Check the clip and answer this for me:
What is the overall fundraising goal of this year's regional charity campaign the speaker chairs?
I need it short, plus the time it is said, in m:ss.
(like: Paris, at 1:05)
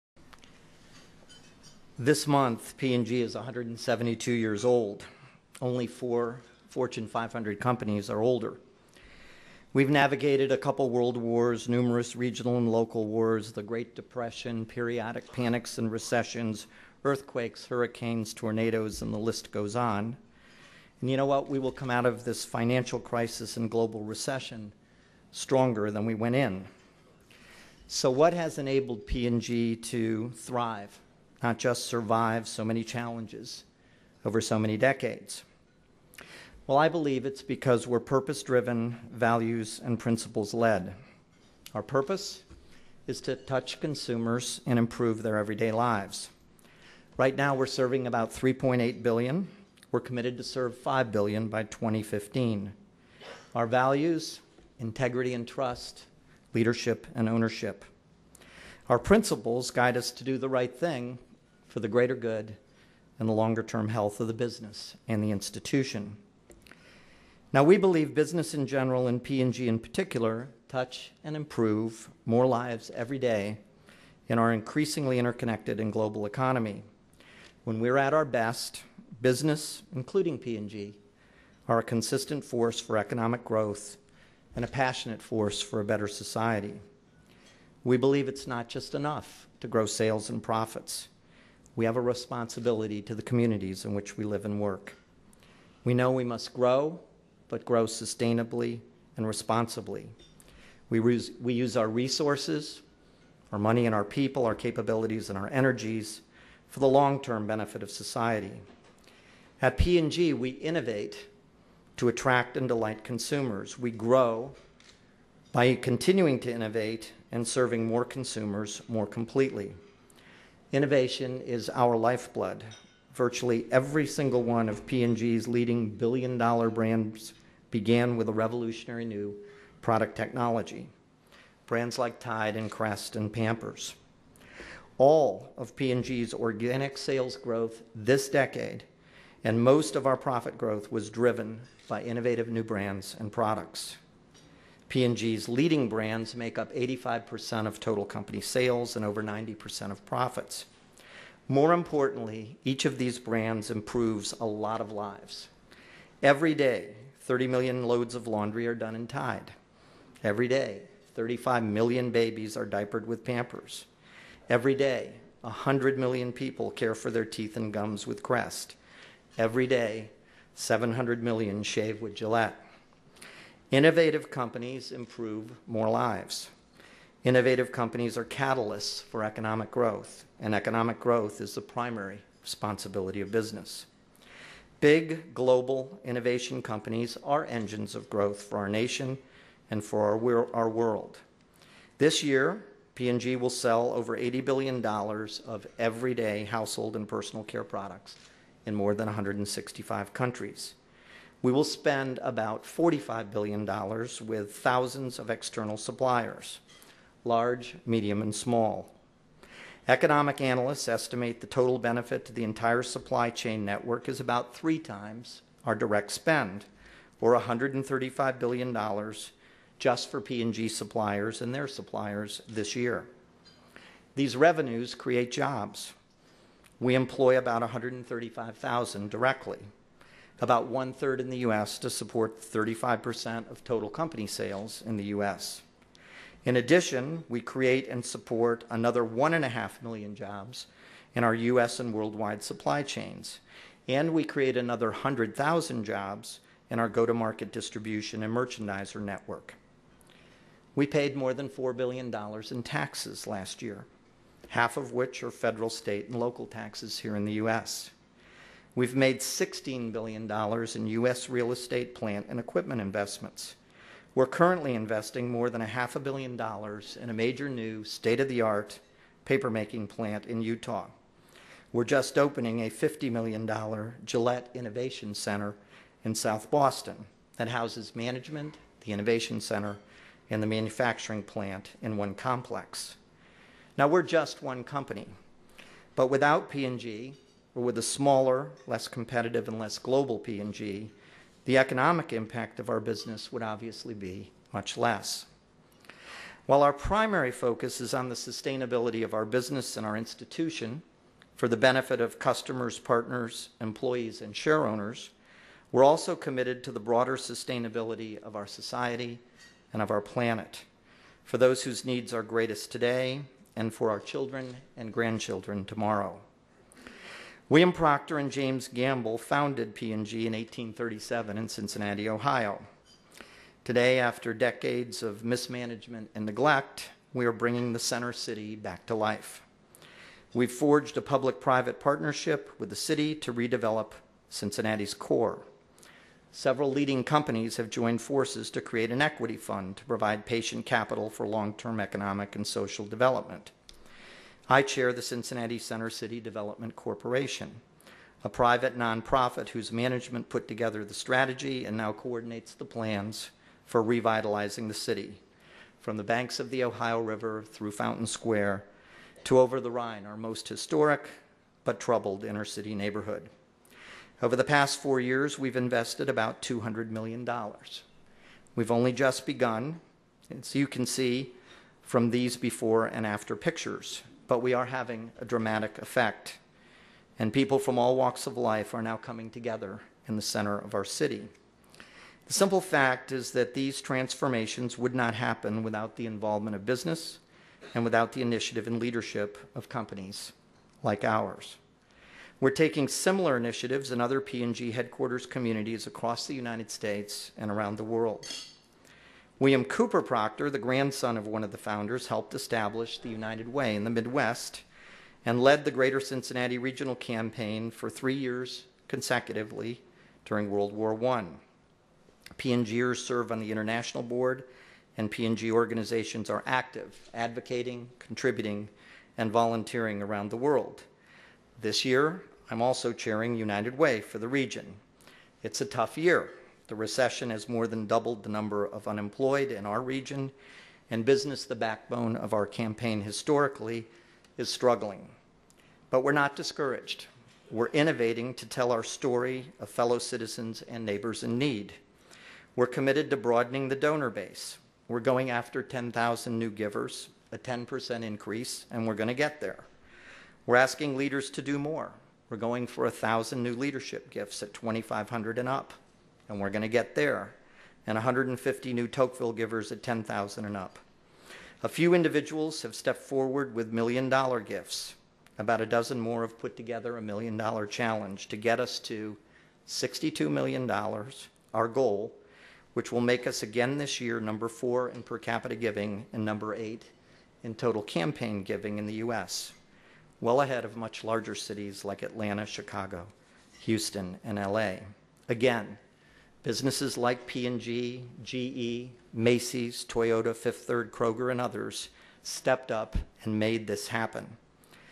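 $62 million, at 7:49.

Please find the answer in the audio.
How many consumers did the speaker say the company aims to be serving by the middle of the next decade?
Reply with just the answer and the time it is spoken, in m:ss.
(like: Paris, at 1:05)
5 billion, at 0:50.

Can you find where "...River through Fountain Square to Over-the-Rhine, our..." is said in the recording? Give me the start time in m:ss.
5:56.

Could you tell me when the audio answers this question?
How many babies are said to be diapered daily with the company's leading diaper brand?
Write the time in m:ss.
2:41.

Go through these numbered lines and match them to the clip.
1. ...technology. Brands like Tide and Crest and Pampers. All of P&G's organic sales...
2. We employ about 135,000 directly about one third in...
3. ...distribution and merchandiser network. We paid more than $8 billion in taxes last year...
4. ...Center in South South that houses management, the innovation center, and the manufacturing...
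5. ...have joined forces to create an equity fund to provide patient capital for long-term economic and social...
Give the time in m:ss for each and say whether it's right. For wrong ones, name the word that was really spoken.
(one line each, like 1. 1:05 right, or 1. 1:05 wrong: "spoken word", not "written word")
1. 2:10 right
2. 3:46 right
3. 4:07 wrong: "4", not "8"
4. 4:35 wrong: "Boston", not "South"
5. 5:37 right.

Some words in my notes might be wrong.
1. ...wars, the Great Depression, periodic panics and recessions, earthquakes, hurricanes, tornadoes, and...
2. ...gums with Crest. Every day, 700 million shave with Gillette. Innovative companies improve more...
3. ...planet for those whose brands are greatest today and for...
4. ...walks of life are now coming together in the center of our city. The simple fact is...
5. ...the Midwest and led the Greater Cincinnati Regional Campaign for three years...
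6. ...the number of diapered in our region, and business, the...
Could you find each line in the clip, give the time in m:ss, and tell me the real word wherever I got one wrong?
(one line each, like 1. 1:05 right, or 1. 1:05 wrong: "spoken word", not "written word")
1. 0:13 right
2. 2:47 right
3. 5:10 wrong: "needs", not "brands"
4. 6:17 right
5. 6:43 right
6. 7:08 wrong: "unemployed", not "diapered".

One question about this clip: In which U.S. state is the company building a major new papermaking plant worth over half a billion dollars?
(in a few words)
Utah.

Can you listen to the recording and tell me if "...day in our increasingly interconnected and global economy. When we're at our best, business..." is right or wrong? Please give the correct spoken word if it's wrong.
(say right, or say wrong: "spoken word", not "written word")
right.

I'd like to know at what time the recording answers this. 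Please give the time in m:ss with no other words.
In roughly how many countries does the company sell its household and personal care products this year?
3:19.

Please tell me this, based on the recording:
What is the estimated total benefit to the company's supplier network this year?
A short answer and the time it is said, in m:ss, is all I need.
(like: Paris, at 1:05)
$135 billion, at 3:37.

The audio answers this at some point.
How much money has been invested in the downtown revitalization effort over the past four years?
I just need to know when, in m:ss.
6:06.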